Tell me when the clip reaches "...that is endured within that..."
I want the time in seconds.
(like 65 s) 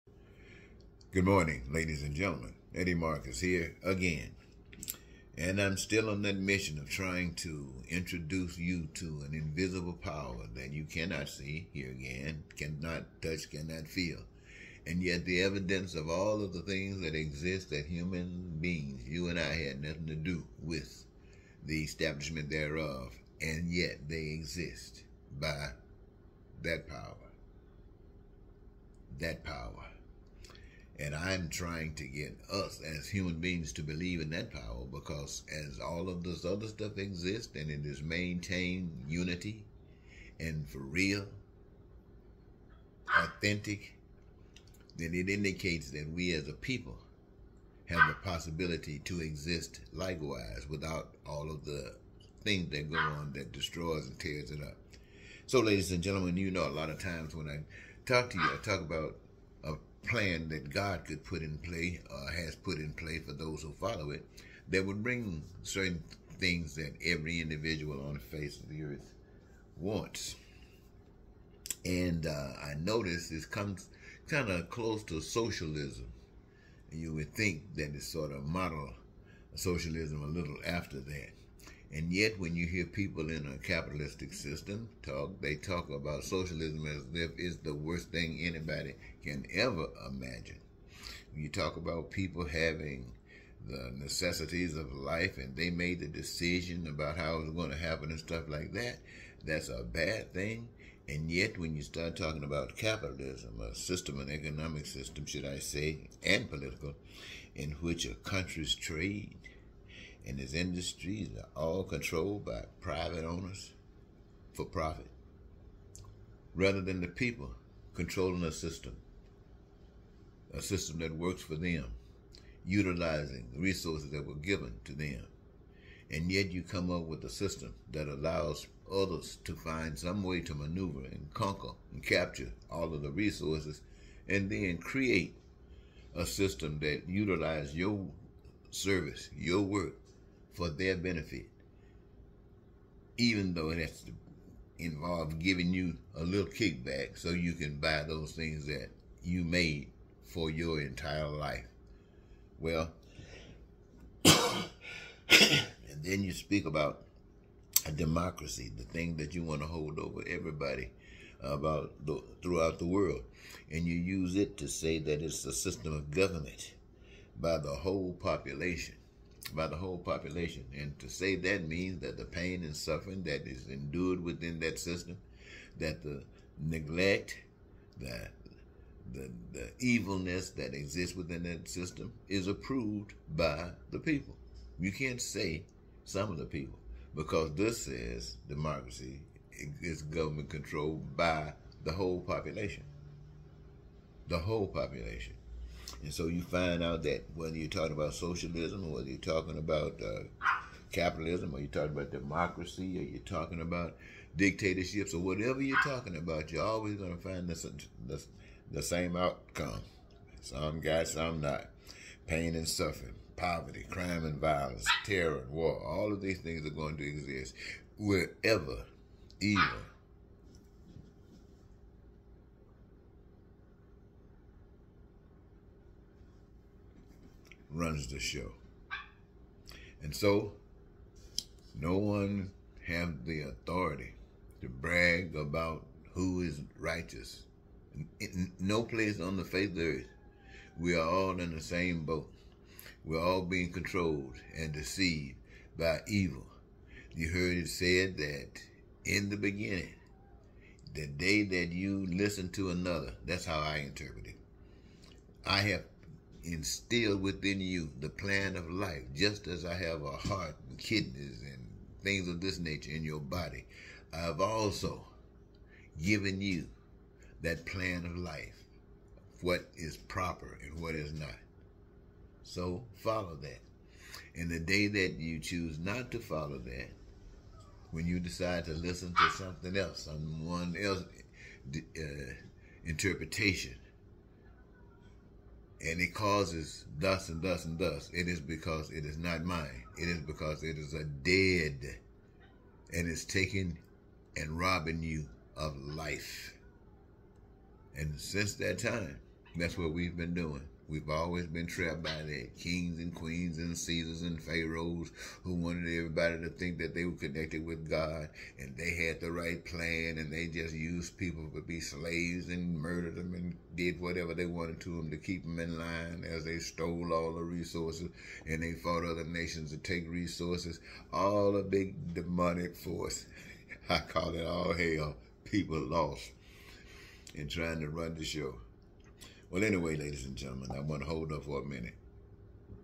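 173 s.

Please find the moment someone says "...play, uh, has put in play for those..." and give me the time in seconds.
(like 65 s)
61 s.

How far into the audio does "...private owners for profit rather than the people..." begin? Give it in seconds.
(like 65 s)
112 s.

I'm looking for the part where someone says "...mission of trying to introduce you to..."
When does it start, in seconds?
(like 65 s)
6 s.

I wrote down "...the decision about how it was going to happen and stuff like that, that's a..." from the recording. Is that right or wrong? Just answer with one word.
right.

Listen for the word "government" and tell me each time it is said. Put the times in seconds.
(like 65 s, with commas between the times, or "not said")
166 s, 190 s.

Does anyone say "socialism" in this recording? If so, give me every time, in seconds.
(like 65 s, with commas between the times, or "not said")
75 s, 79 s, 86 s, 198 s.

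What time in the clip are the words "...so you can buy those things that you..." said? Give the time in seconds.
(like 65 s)
147 s.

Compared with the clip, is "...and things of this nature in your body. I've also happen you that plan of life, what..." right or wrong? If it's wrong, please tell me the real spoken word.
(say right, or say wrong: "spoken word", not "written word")
wrong: "given", not "happen".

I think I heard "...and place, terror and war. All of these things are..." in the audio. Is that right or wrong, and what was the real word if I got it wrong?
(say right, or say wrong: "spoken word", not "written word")
wrong: "violence", not "place".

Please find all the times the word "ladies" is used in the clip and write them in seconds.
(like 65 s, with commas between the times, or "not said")
1 s, 55 s, 329 s.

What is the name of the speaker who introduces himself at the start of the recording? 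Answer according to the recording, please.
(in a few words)
Eddie Marcus.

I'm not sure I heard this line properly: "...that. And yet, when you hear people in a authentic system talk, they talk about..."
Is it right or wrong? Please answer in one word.
wrong.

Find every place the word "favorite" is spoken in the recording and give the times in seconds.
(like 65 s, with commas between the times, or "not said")
not said.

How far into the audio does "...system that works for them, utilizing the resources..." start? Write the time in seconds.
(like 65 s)
120 s.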